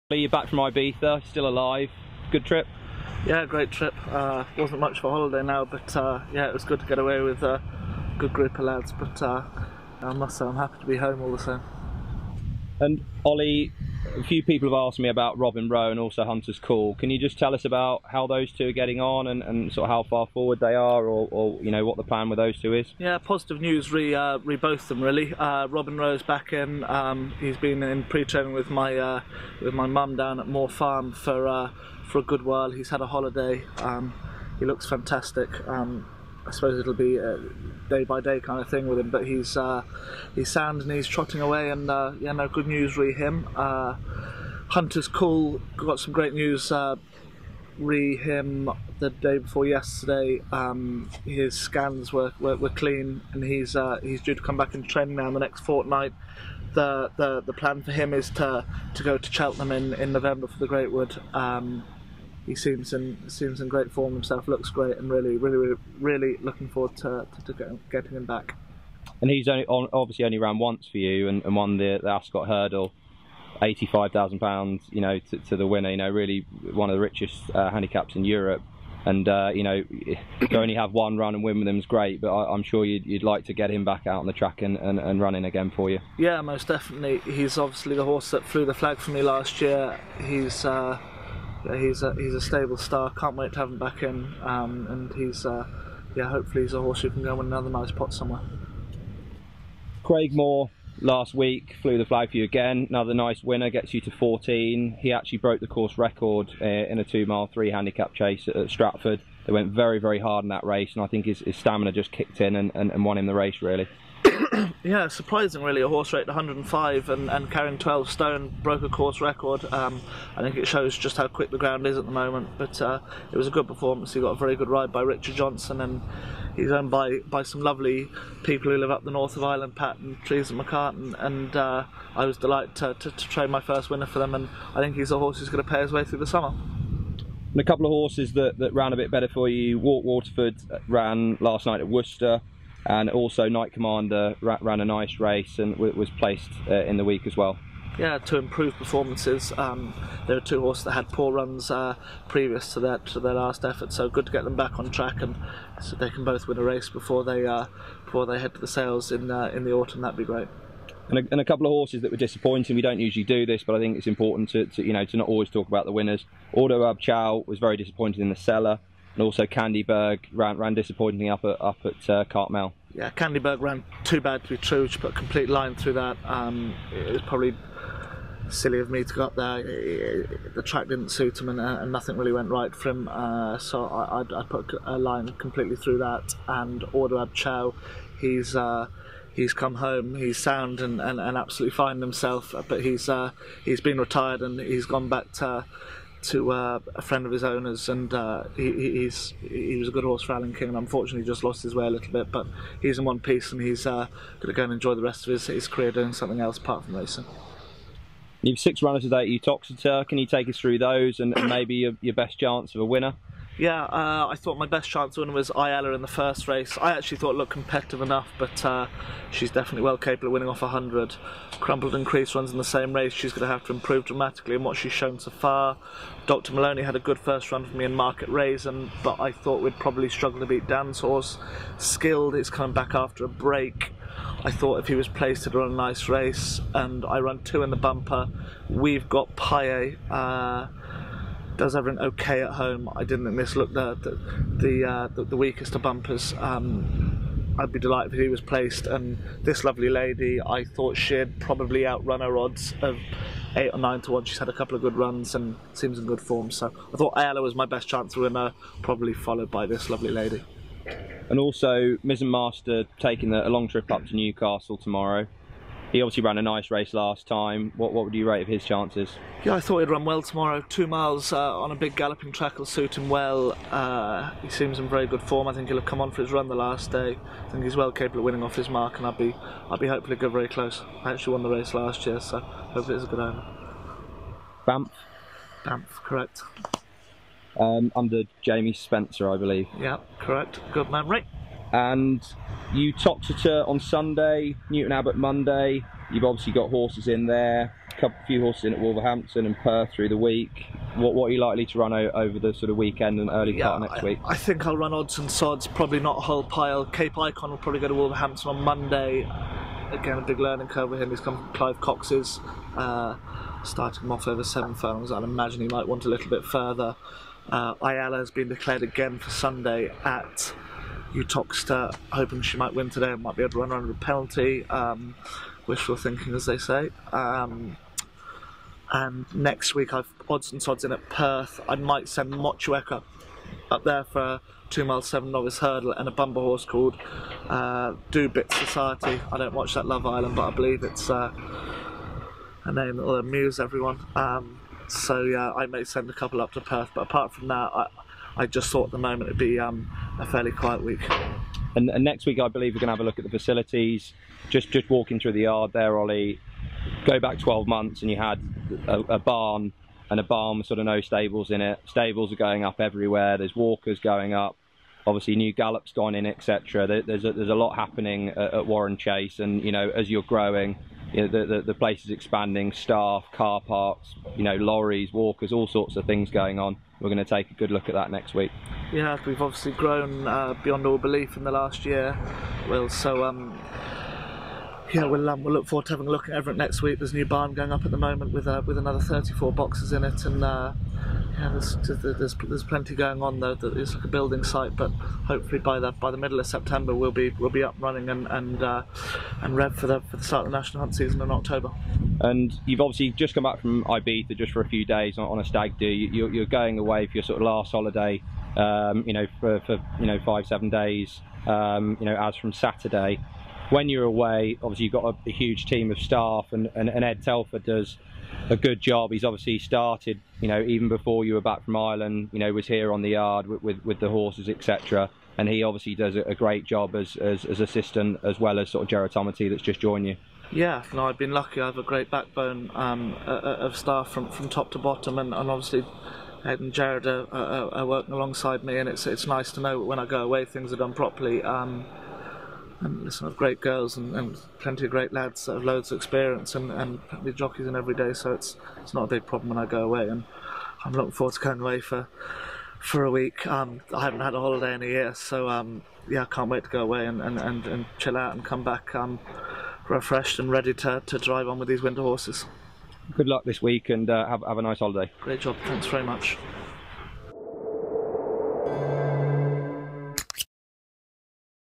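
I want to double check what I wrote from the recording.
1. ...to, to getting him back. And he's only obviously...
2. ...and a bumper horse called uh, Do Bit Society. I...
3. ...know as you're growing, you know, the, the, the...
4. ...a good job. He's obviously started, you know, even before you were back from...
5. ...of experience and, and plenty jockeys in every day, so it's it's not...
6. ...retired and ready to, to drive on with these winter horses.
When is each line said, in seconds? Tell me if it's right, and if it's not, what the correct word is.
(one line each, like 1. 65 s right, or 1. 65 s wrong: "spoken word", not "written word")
1. 67 s right
2. 335 s right
3. 369 s right
4. 418 s right
5. 445 s right
6. 459 s wrong: "refreshed", not "retired".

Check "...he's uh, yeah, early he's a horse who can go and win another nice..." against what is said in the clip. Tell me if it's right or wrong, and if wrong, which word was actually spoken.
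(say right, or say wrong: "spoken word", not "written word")
wrong: "hopefully", not "early".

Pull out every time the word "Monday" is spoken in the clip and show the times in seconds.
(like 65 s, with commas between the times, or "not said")
295 s, 308 s.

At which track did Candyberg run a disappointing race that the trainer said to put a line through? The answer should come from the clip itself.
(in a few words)
Cartmel.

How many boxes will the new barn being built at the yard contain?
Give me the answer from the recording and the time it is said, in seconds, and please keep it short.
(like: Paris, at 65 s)
34, at 388 s.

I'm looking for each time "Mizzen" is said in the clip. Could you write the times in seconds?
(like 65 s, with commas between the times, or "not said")
262 s.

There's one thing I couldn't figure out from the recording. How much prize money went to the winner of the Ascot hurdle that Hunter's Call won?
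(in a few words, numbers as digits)
£85,000.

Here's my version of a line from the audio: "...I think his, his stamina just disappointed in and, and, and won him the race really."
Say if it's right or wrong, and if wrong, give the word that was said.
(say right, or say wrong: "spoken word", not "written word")
wrong: "kicked", not "disappointed".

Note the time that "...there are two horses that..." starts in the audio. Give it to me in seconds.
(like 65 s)
150 s.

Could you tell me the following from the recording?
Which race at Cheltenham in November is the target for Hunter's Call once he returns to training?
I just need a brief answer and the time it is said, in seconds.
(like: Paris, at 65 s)
The Greatwood, at 60 s.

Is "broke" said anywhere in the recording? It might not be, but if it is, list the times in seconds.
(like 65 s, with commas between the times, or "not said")
105 s, 118 s.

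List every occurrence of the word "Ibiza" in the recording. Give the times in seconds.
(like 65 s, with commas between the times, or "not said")
0 s, 403 s.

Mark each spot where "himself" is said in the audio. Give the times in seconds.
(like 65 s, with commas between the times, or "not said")
64 s, 192 s.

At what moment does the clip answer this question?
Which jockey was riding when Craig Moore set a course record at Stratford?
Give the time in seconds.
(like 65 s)
125 s.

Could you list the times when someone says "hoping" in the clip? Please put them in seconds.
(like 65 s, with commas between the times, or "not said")
322 s.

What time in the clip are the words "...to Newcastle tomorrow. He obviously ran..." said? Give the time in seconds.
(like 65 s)
264 s.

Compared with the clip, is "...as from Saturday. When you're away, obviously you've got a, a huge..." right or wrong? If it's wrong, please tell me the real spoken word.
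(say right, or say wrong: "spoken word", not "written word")
right.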